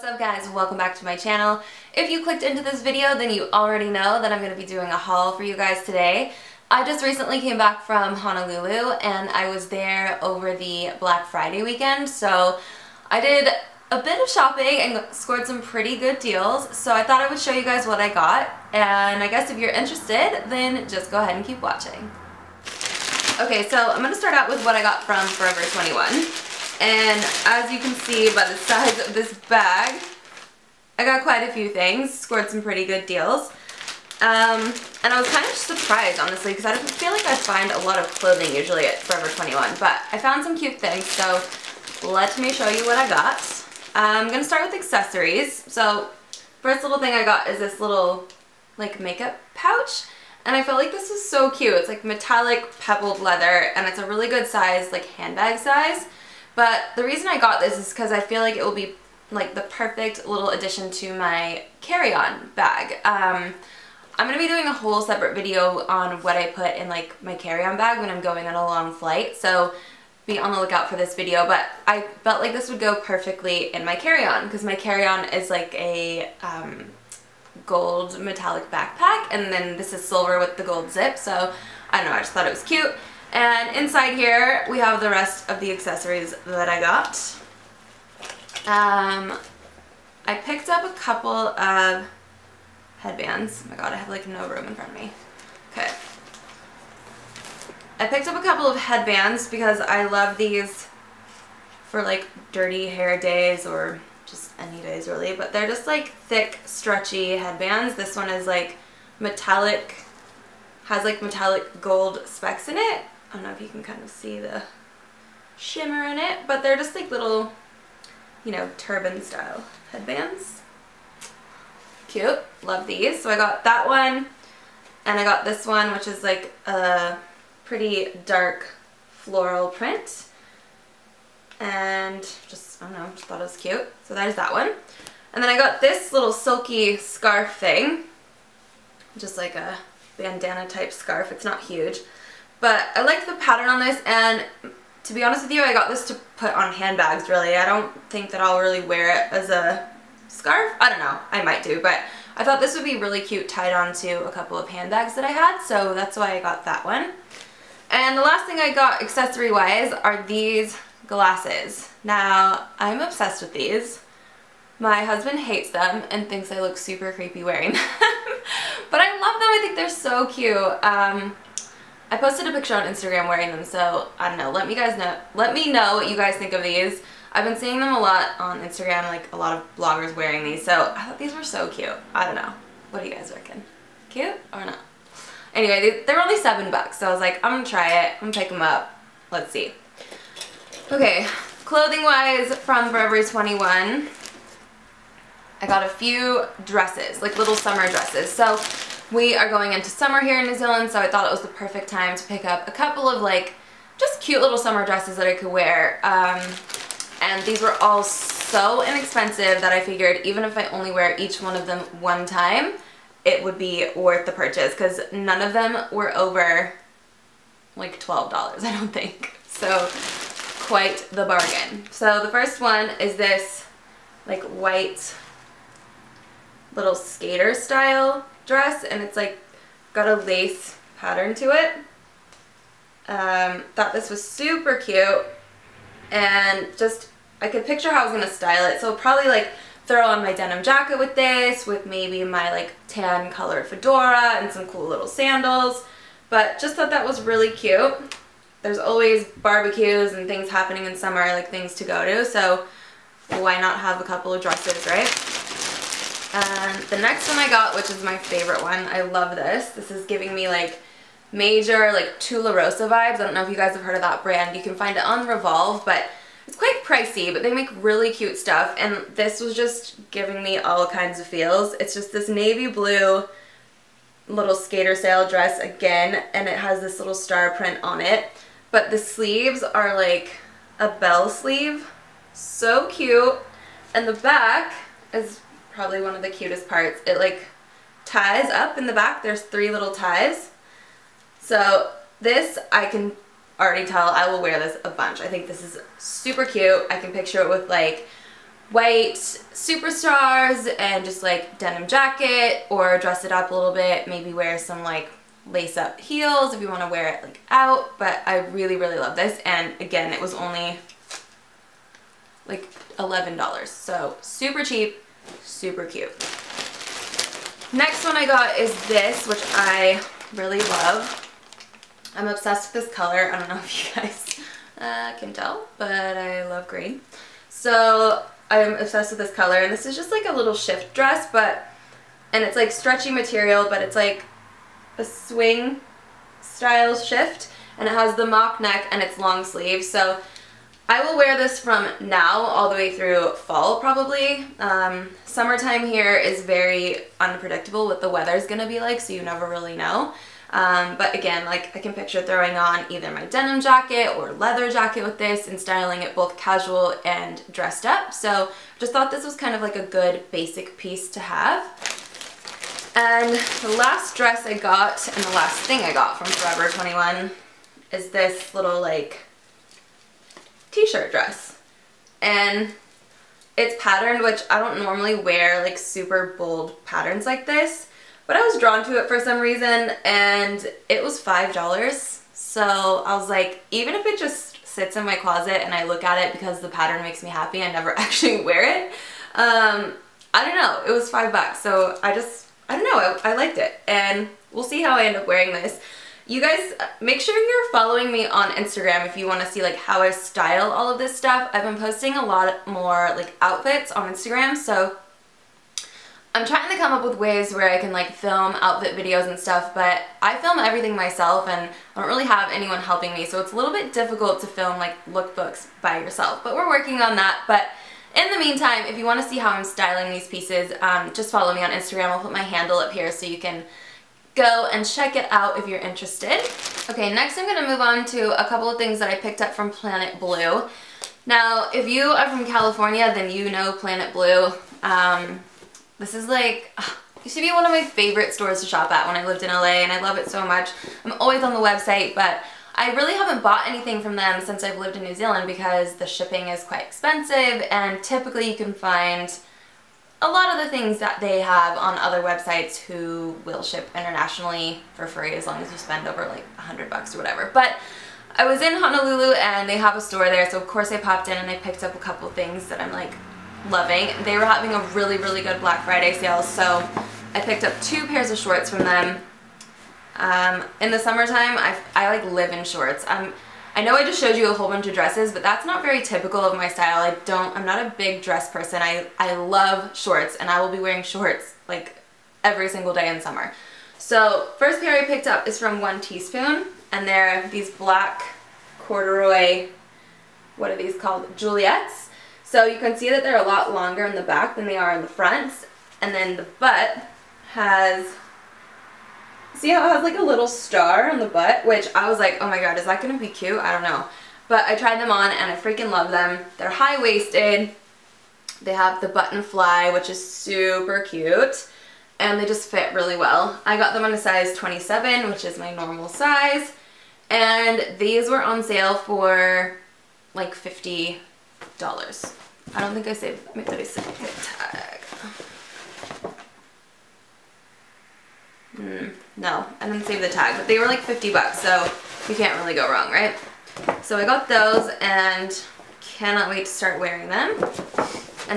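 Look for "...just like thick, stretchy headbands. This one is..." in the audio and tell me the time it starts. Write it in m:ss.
1:45.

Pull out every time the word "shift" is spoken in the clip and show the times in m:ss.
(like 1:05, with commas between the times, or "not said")
5:30, 5:36.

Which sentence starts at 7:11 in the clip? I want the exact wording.
Now, if you are from California, then you know Planet Blue.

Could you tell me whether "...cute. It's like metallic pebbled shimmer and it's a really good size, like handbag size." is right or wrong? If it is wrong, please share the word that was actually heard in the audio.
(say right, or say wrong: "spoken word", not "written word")
wrong: "leather", not "shimmer".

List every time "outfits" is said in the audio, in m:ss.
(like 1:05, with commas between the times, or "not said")
6:43, 6:48.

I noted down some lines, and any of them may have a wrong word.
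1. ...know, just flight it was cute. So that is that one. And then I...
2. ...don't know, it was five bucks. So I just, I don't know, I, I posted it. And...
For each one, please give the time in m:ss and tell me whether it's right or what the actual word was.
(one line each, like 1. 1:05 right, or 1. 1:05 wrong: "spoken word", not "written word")
1. 2:12 wrong: "thought", not "flight"
2. 6:30 wrong: "liked", not "posted".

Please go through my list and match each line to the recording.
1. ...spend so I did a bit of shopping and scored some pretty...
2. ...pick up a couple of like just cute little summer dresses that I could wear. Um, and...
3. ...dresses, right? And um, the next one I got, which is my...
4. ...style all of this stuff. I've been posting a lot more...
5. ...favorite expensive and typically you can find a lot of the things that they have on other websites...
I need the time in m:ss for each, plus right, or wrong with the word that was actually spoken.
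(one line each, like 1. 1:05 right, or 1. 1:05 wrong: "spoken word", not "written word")
1. 0:11 wrong: "weekend", not "spend"
2. 3:22 right
3. 4:14 right
4. 6:40 right
5. 7:26 wrong: "quite", not "favorite".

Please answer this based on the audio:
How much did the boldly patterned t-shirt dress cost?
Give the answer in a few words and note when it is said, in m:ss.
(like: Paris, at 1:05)
$5, at 6:21.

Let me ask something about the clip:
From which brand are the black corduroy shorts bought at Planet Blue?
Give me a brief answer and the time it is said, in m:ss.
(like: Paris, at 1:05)
One Teaspoon, at 8:05.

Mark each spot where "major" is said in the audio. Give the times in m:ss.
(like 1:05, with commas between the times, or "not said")
4:21.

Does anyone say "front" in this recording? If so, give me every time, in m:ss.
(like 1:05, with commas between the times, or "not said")
1:34, 8:15.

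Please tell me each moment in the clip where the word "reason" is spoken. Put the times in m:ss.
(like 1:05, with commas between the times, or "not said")
0:57, 6:19.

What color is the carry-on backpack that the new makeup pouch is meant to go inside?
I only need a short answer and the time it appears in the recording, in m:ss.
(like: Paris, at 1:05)
gold metallic, at 1:17.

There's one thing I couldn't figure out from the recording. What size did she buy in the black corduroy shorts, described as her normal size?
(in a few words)
27.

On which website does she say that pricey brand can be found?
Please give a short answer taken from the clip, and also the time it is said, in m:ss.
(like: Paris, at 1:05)
Revolve, at 4:25.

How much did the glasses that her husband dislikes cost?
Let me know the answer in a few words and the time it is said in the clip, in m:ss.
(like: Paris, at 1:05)
$7, at 3:06.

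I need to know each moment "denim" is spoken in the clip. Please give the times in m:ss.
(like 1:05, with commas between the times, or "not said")
4:00, 5:01, 5:53.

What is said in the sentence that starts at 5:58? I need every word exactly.
So just thought this was kind of like a good basic piece to have.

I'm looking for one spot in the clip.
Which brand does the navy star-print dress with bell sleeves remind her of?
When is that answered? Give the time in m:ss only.
4:22.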